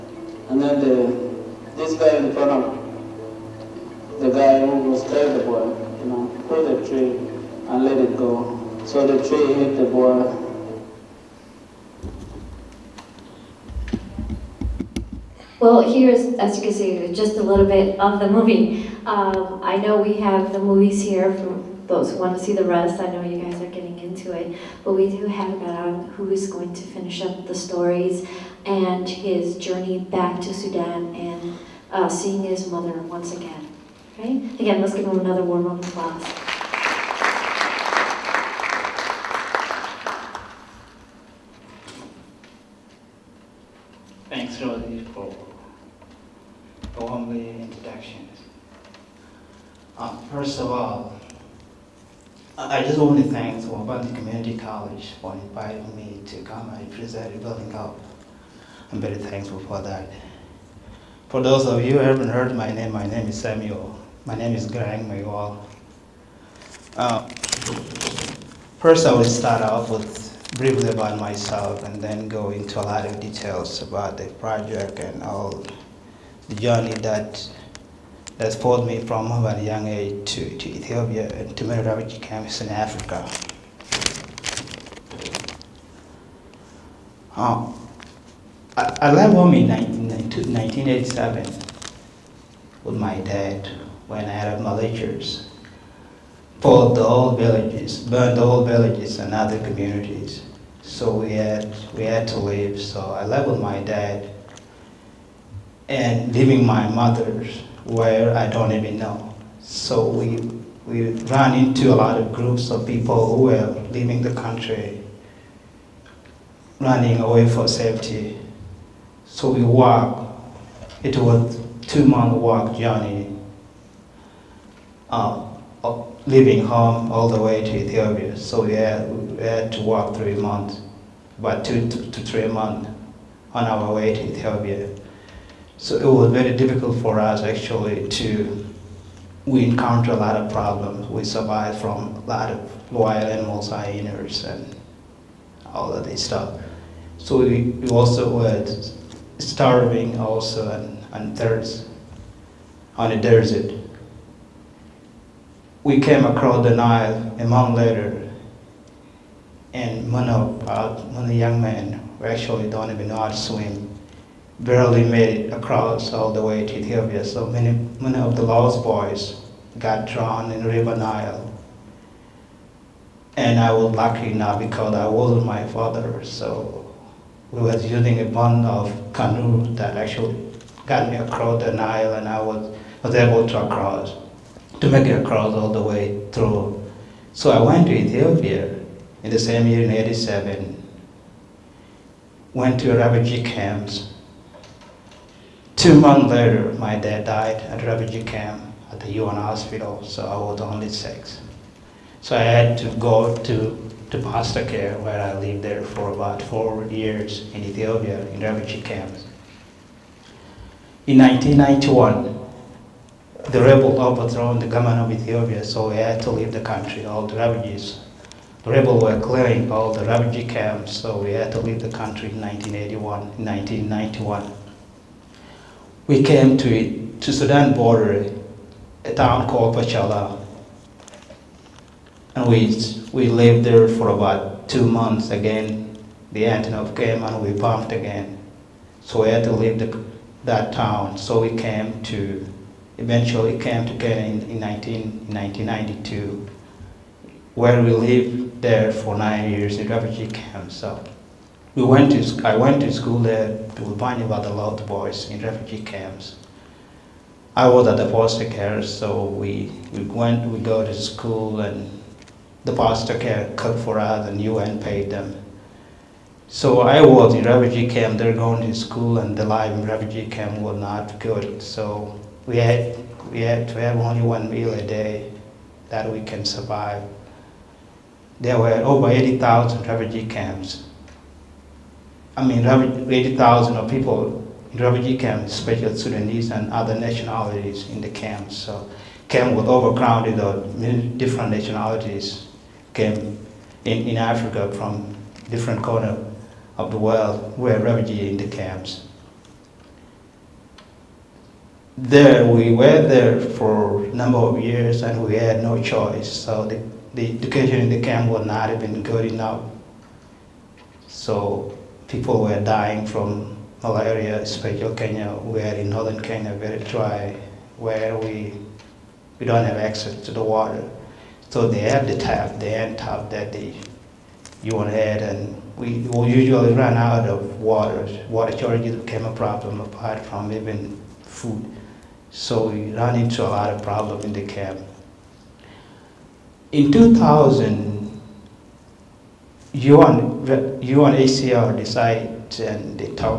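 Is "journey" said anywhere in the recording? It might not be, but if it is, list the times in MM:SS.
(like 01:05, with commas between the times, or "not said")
00:29, 01:16, 02:02.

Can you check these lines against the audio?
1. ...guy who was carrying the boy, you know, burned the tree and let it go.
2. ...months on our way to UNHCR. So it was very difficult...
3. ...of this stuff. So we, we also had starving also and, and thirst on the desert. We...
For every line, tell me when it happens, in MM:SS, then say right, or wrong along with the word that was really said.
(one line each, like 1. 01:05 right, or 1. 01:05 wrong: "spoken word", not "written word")
1. 00:04 wrong: "pulled", not "burned"
2. 02:12 wrong: "Ethiopia", not "UNHCR"
3. 02:25 right.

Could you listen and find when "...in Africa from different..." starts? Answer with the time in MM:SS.
04:54.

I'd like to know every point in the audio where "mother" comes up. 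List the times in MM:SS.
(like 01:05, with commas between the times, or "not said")
00:32, 01:46.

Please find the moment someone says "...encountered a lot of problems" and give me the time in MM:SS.
02:19.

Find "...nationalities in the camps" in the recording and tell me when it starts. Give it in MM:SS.
04:46.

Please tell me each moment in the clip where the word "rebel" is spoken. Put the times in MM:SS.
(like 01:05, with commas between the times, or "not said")
03:33, 03:38.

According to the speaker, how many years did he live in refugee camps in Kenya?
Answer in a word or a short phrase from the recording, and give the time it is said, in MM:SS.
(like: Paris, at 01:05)
9, at 04:09.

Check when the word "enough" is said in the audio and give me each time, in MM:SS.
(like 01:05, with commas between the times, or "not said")
02:54, 05:09.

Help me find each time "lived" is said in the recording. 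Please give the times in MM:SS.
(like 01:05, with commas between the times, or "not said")
03:25, 03:53, 04:07.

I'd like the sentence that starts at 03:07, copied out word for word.
So I went to Ethiopia in the same year in 87, went to a refugee camps.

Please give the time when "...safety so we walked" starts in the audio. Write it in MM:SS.
01:57.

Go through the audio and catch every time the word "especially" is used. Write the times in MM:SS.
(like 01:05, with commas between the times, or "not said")
04:45, 05:14.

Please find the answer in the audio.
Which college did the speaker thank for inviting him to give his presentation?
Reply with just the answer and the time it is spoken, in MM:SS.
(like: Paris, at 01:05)
Waubonsee Community College, at 00:53.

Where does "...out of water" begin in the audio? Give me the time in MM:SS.
05:26.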